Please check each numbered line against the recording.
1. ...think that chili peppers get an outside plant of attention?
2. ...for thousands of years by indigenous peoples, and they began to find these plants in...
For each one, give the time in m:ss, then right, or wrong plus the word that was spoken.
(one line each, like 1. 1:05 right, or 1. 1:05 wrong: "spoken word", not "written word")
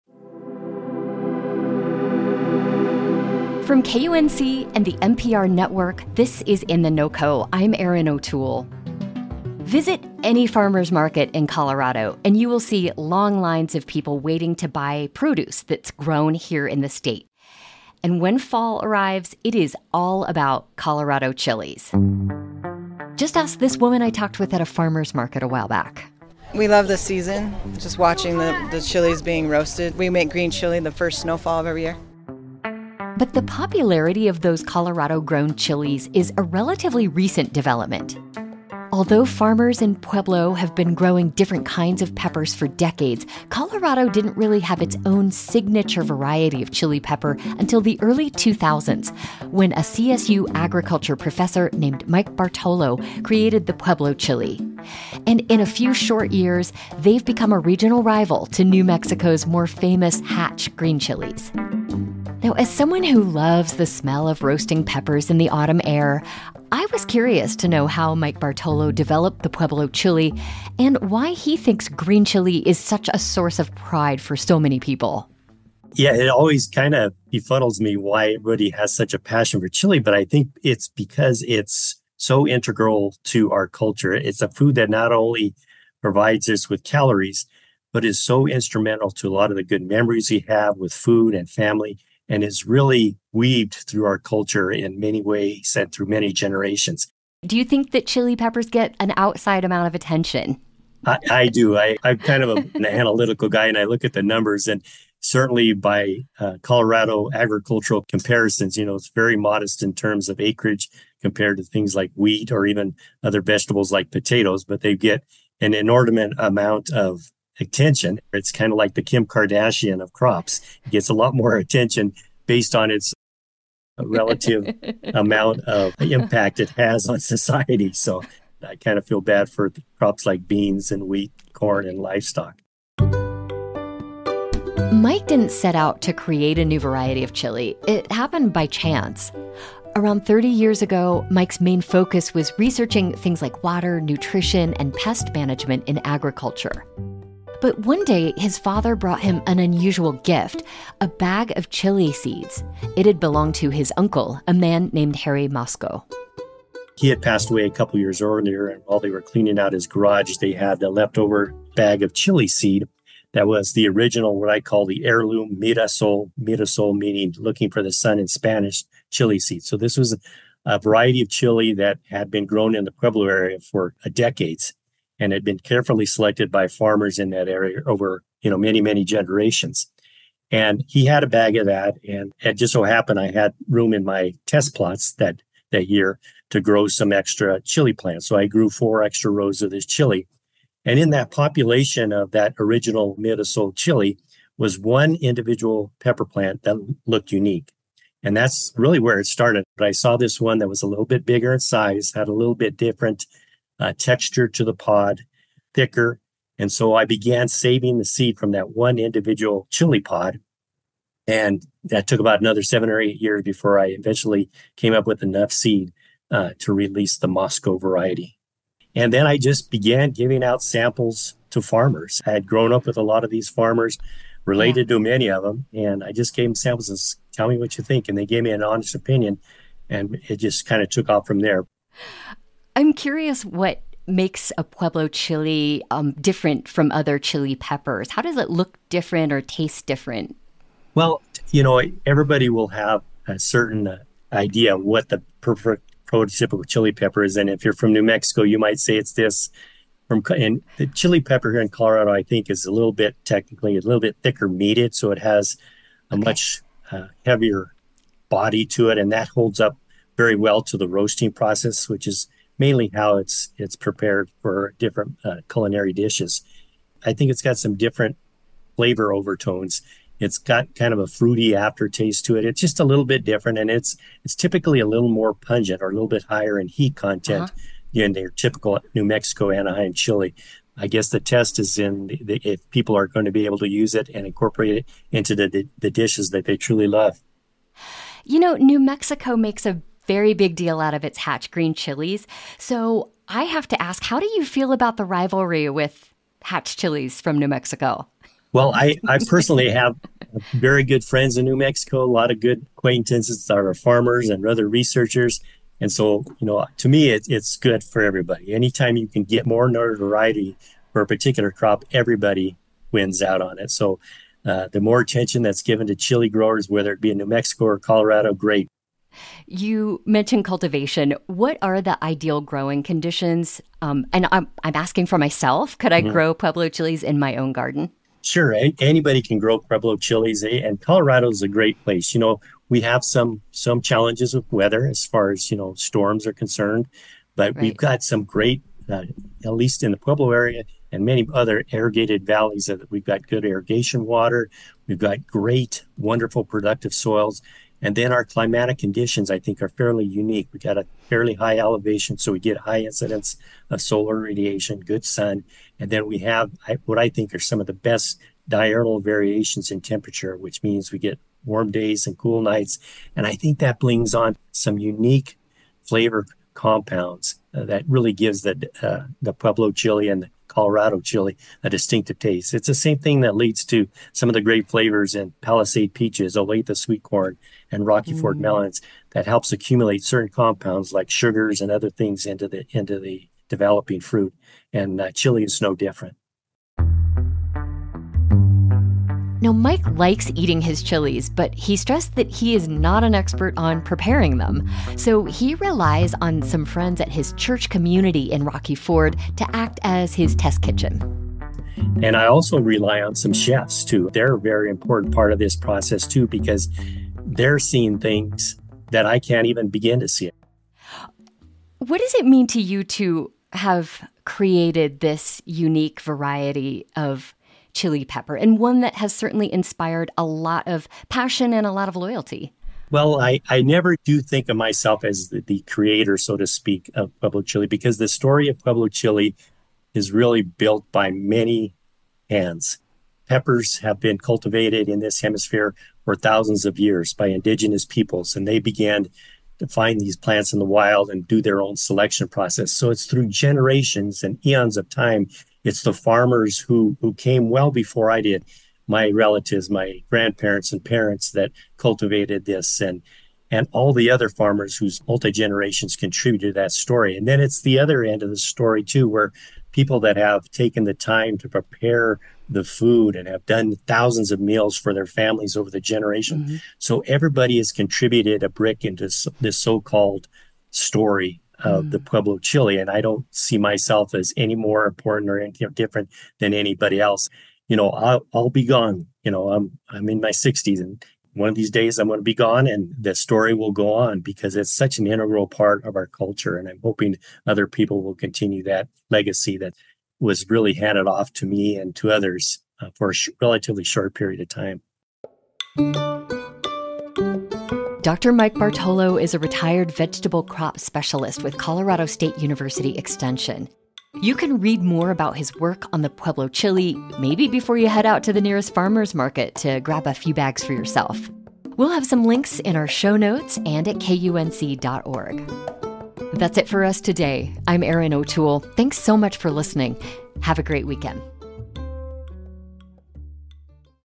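1. 1:37 wrong: "amount", not "plant"
2. 7:16 right.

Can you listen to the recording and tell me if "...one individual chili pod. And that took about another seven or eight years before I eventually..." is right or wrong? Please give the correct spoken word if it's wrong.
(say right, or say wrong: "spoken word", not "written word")
right.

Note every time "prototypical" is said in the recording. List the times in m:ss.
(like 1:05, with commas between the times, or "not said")
4:06.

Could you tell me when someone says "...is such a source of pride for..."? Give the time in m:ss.
1:12.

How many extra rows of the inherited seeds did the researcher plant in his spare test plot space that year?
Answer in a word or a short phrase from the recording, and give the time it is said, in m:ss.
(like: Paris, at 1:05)
4, at 3:08.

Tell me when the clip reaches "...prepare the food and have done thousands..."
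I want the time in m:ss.
7:41.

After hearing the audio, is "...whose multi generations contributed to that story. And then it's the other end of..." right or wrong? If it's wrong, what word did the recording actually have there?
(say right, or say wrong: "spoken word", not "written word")
right.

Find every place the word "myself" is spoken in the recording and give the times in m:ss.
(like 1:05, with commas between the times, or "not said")
5:25, 7:04, 7:53.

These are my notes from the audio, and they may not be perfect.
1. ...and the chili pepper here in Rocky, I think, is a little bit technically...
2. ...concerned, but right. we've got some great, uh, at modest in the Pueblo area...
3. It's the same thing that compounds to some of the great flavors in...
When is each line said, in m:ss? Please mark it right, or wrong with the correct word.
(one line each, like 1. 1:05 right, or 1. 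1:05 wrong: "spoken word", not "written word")
1. 4:10 wrong: "Colorado", not "Rocky"
2. 5:36 wrong: "least", not "modest"
3. 6:12 wrong: "leads", not "compounds".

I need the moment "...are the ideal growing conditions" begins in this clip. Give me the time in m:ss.
5:21.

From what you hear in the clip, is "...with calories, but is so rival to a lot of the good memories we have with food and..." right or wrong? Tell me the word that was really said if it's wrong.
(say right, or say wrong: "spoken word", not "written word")
wrong: "instrumental", not "rival".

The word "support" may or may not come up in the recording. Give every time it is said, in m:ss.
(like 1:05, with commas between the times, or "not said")
not said.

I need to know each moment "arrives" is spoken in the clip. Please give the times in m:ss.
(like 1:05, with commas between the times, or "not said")
0:18.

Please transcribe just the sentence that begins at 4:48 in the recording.
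You know, New Mexico makes a very big deal out of its Hatch Green Chilies.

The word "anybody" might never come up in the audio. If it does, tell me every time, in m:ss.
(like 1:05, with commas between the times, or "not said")
5:28, 7:56.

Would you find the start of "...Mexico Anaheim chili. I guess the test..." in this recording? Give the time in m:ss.
4:39.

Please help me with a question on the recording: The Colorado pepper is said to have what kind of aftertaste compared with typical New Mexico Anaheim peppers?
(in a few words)
Fruity.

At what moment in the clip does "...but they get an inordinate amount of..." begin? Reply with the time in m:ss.
1:54.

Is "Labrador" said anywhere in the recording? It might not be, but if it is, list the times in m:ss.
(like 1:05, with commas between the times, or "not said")
not said.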